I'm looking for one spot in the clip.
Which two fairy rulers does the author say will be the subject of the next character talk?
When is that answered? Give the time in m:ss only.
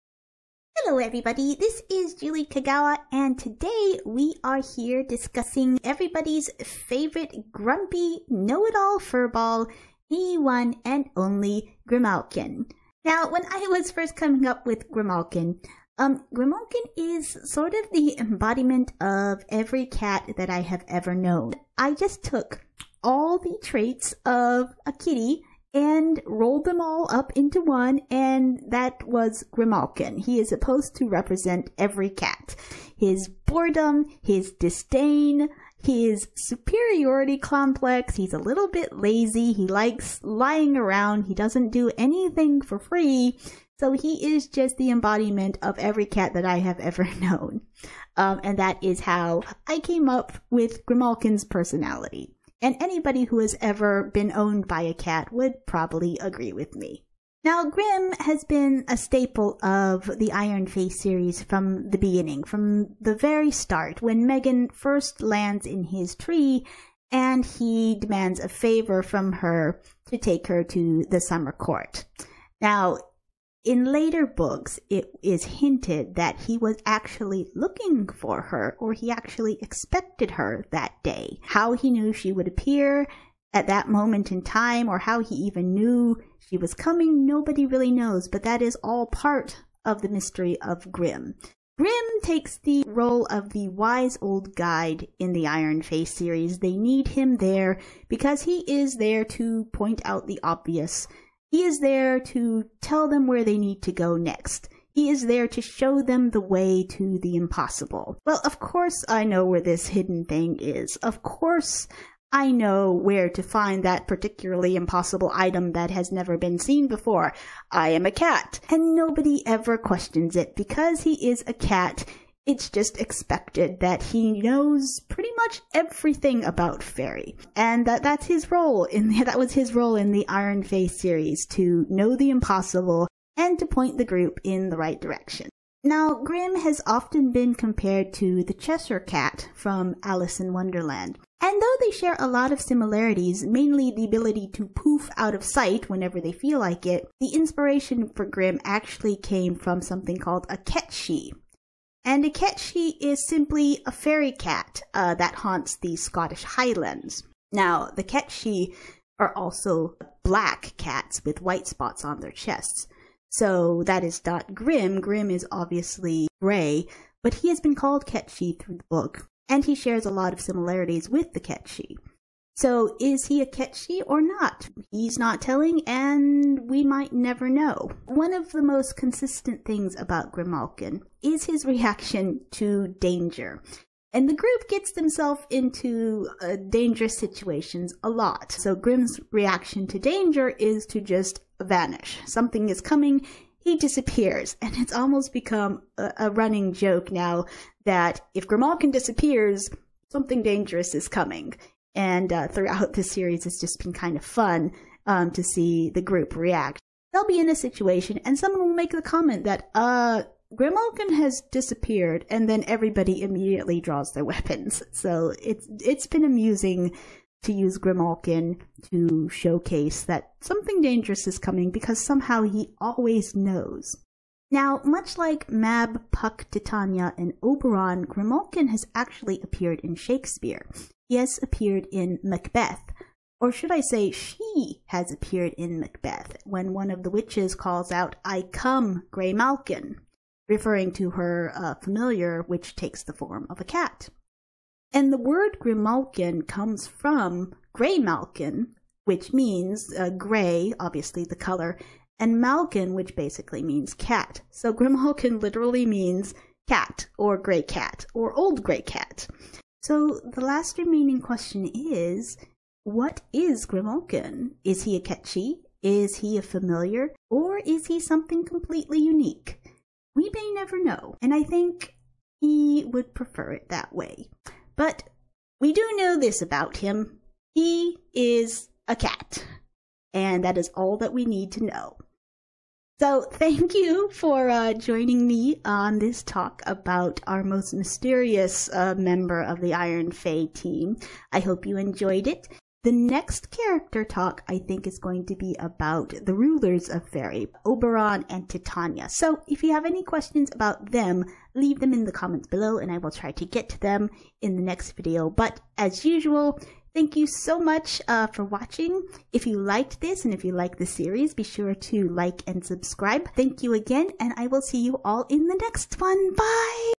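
4:57.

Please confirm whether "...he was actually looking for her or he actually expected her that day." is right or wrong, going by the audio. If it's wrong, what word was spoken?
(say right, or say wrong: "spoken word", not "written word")
right.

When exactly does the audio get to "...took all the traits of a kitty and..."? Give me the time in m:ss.
0:22.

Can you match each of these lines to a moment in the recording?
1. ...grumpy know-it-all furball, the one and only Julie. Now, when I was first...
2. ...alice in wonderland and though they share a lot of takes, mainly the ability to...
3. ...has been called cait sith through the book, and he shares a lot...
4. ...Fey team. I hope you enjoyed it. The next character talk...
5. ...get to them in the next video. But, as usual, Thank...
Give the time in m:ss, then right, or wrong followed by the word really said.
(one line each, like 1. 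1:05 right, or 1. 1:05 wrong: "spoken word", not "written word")
1. 0:07 wrong: "Grimalkin", not "Julie"
2. 2:20 wrong: "similarities", not "takes"
3. 2:47 right
4. 4:50 right
5. 5:03 right.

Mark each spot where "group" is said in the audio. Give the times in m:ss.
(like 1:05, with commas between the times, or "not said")
2:14, 3:04, 3:26.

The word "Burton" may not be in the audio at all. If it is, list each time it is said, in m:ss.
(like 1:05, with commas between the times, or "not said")
not said.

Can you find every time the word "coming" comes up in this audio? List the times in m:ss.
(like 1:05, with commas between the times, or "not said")
0:14, 1:26, 3:12, 3:21, 3:41.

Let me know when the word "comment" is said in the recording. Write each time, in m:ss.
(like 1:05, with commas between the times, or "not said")
3:29, 5:02.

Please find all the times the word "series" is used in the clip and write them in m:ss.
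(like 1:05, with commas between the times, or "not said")
1:00, 1:36, 2:10, 3:23, 5:10.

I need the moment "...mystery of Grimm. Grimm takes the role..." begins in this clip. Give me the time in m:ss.
1:30.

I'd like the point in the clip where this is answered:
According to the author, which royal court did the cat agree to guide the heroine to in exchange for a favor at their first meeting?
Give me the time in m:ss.
1:11.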